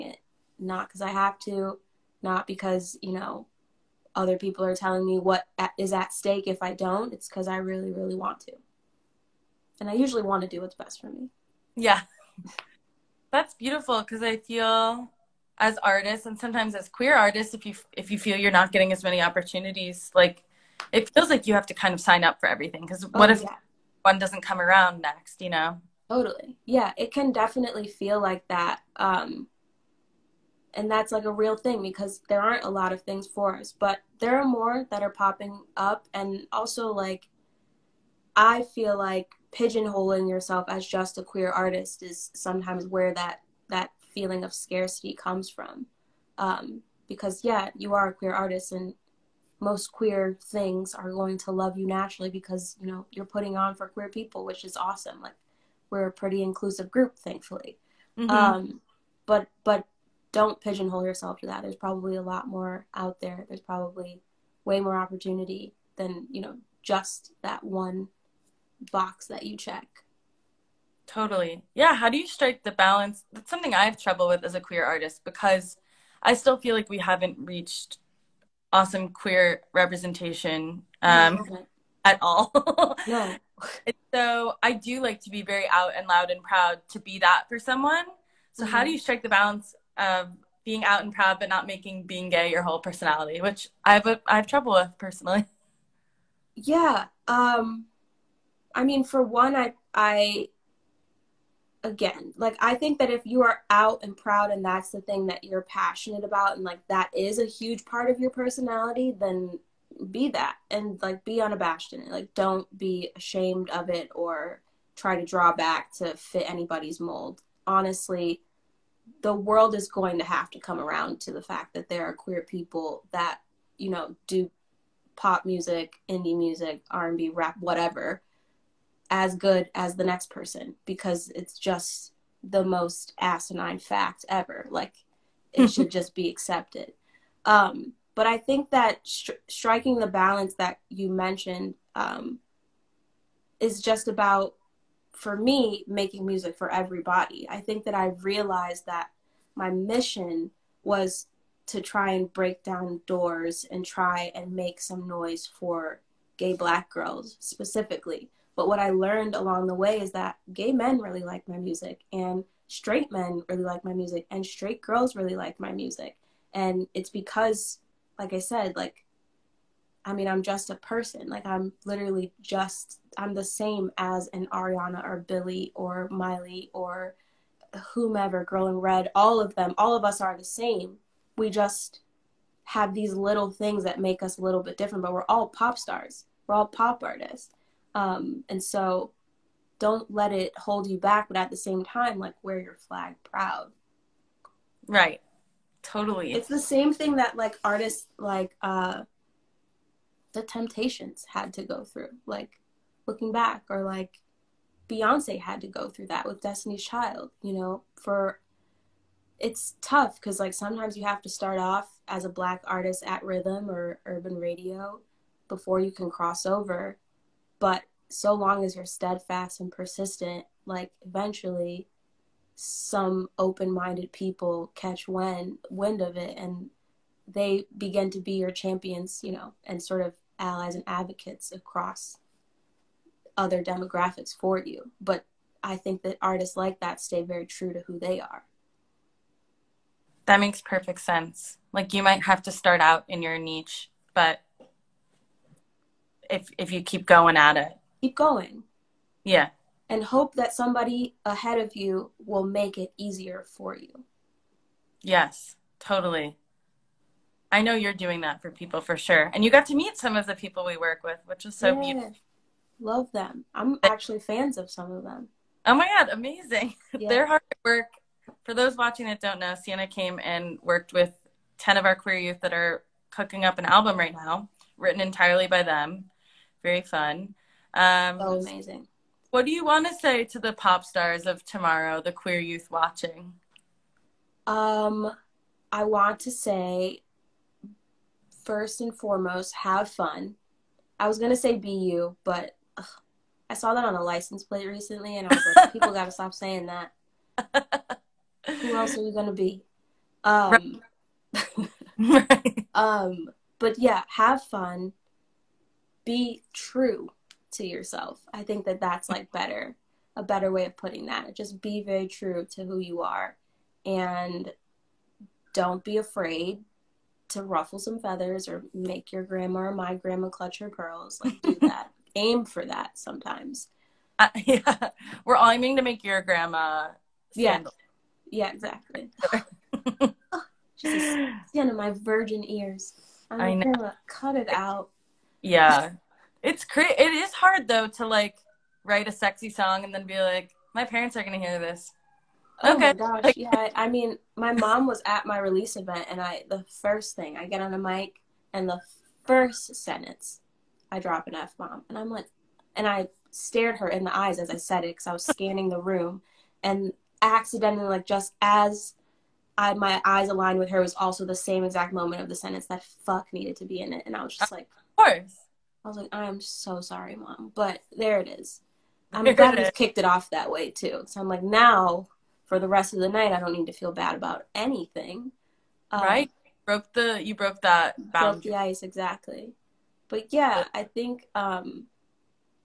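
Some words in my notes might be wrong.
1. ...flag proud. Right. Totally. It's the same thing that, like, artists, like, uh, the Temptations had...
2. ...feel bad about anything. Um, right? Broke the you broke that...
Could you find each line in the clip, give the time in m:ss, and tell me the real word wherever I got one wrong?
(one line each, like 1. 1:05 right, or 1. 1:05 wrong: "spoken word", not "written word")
1. 3:12 right
2. 6:13 right.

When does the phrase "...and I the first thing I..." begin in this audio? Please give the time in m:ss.
5:46.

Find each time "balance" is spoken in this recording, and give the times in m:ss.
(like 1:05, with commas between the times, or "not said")
1:12, 1:29, 2:20.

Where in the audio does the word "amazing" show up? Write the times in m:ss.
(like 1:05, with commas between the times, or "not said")
4:26, 4:38.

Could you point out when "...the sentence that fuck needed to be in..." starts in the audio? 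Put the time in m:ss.
6:02.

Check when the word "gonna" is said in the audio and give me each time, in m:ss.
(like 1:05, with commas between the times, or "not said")
4:51, 4:59.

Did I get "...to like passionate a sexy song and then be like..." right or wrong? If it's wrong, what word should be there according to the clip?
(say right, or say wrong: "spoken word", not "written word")
wrong: "write", not "passionate".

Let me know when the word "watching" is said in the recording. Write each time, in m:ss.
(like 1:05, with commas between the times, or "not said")
4:28, 4:42.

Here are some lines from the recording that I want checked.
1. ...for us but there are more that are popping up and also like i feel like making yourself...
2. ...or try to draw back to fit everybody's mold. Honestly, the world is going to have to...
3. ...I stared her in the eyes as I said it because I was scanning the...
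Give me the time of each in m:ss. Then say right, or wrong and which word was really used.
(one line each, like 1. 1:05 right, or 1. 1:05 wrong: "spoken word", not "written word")
1. 0:33 wrong: "pigeonholing", not "making"
2. 1:54 wrong: "anybody", not "everybody"
3. 5:52 right.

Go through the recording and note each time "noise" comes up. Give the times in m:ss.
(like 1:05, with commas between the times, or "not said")
2:35.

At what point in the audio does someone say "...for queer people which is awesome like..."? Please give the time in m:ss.
0:53.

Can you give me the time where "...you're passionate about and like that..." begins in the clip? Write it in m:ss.
1:45.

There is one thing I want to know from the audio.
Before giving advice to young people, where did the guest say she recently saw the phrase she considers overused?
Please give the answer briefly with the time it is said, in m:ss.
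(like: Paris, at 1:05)
license plate, at 4:54.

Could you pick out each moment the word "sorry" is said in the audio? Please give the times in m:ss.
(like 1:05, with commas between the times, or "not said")
6:06.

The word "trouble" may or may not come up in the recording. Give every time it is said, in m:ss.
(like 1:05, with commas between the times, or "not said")
1:14, 1:34.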